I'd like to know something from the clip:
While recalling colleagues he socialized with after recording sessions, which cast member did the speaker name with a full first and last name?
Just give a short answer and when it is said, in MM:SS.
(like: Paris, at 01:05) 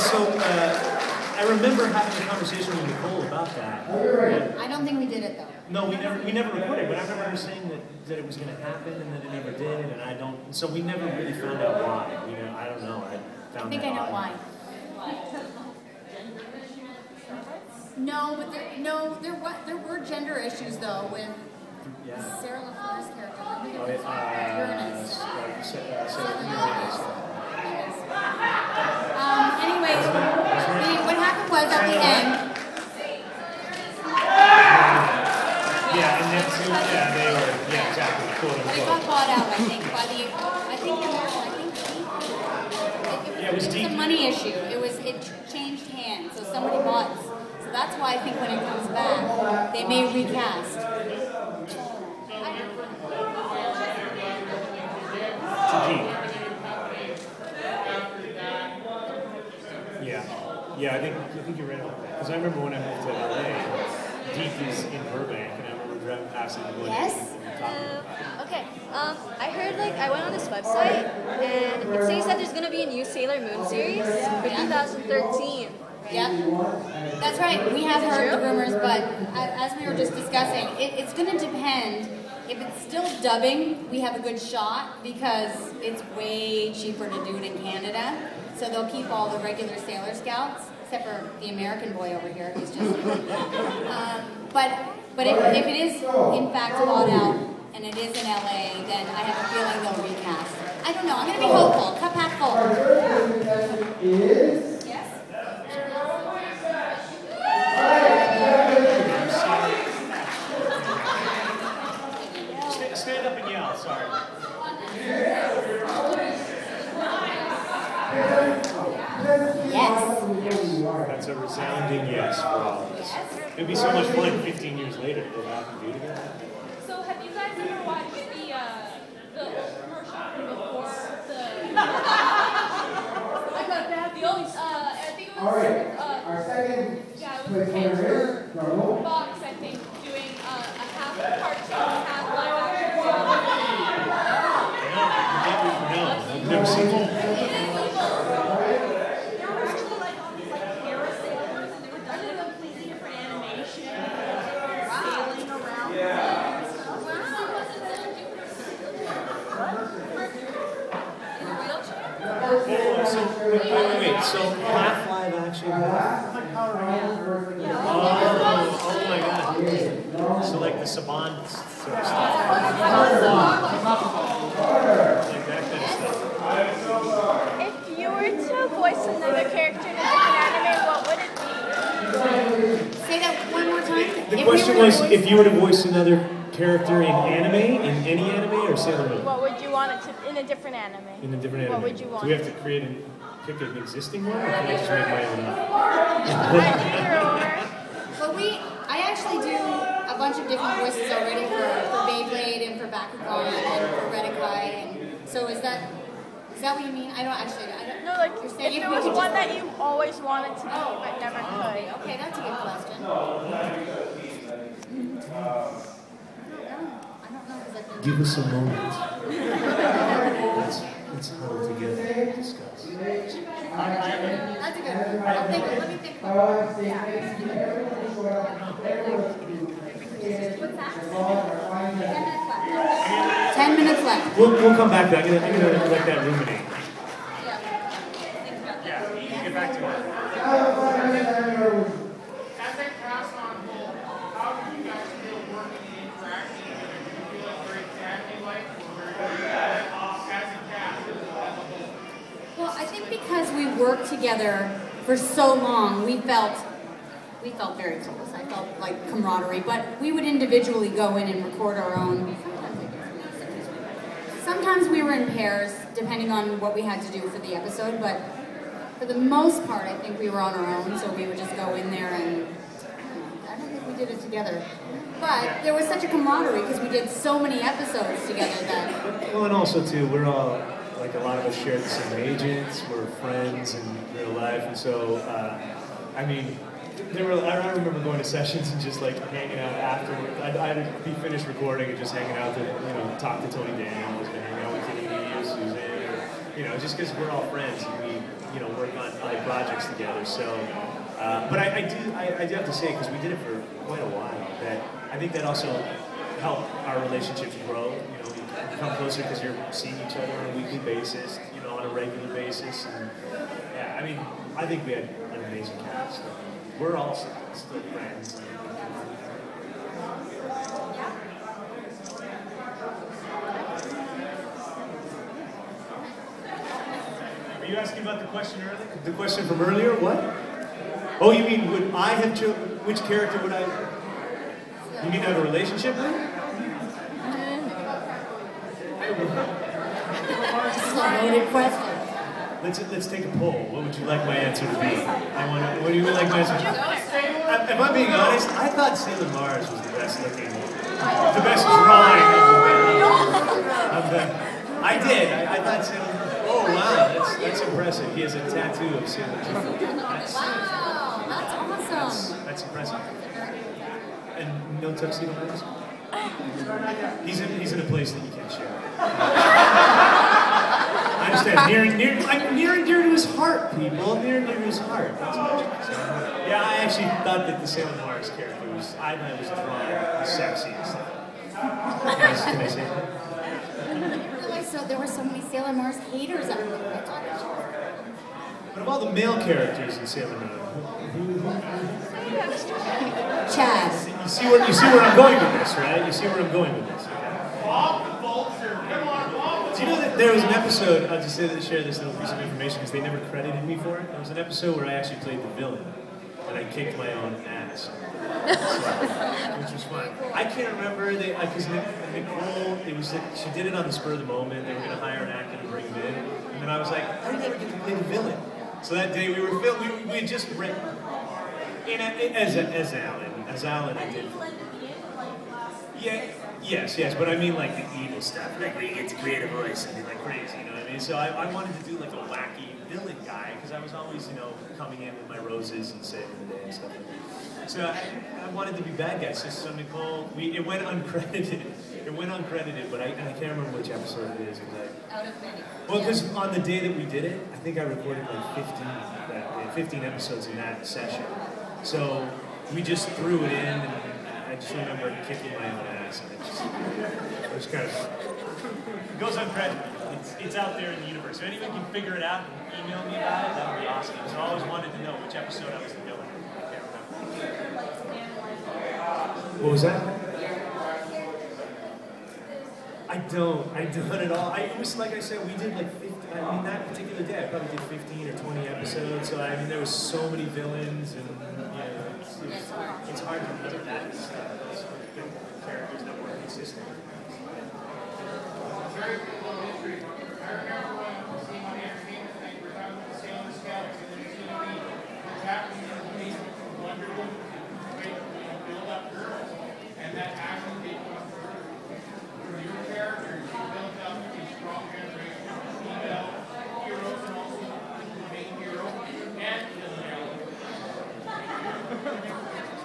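Tony Daniels, at 04:53.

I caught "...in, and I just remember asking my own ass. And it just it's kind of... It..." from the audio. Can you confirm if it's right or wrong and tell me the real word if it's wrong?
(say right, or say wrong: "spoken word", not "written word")
wrong: "kicking", not "asking".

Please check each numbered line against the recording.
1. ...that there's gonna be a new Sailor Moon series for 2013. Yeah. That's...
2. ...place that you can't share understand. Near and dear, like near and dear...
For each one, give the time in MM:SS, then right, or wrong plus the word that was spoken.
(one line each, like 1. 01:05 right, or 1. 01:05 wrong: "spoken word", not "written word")
1. 01:12 right
2. 06:07 right.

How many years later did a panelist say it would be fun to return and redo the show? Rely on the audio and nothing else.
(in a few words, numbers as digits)
15 years.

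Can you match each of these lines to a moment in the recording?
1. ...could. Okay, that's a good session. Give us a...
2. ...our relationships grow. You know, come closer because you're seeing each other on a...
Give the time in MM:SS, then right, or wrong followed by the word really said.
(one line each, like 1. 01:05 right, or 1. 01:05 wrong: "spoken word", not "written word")
1. 03:31 wrong: "question", not "session"
2. 05:06 right.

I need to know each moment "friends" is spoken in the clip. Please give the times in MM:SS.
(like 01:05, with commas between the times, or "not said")
04:43, 04:57, 05:17.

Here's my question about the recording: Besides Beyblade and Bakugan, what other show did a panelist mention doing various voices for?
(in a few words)
Redakai.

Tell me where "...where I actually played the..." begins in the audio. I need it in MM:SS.
06:44.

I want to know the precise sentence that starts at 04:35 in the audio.
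But there was such a camaraderie because we did so many episodes together that.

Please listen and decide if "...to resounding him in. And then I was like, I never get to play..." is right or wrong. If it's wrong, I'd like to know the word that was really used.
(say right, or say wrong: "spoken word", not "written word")
wrong: "bring", not "resounding".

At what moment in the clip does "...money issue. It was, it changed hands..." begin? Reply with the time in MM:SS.
00:43.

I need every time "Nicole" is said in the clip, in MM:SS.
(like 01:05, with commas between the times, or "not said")
00:02, 06:51, 07:19.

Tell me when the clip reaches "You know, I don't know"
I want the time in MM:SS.
00:12.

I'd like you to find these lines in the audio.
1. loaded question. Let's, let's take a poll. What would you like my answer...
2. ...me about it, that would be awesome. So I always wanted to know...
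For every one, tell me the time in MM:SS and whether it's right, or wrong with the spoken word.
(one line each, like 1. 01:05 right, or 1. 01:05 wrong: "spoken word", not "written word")
1. 05:41 right
2. 07:43 right.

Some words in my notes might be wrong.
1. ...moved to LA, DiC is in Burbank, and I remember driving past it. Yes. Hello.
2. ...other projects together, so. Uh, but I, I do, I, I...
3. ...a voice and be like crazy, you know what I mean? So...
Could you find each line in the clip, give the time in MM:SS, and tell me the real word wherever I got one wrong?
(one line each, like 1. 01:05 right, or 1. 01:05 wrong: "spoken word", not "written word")
1. 01:02 right
2. 04:59 right
3. 07:09 right.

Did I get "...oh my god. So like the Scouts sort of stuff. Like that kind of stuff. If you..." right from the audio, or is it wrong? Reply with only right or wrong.
wrong.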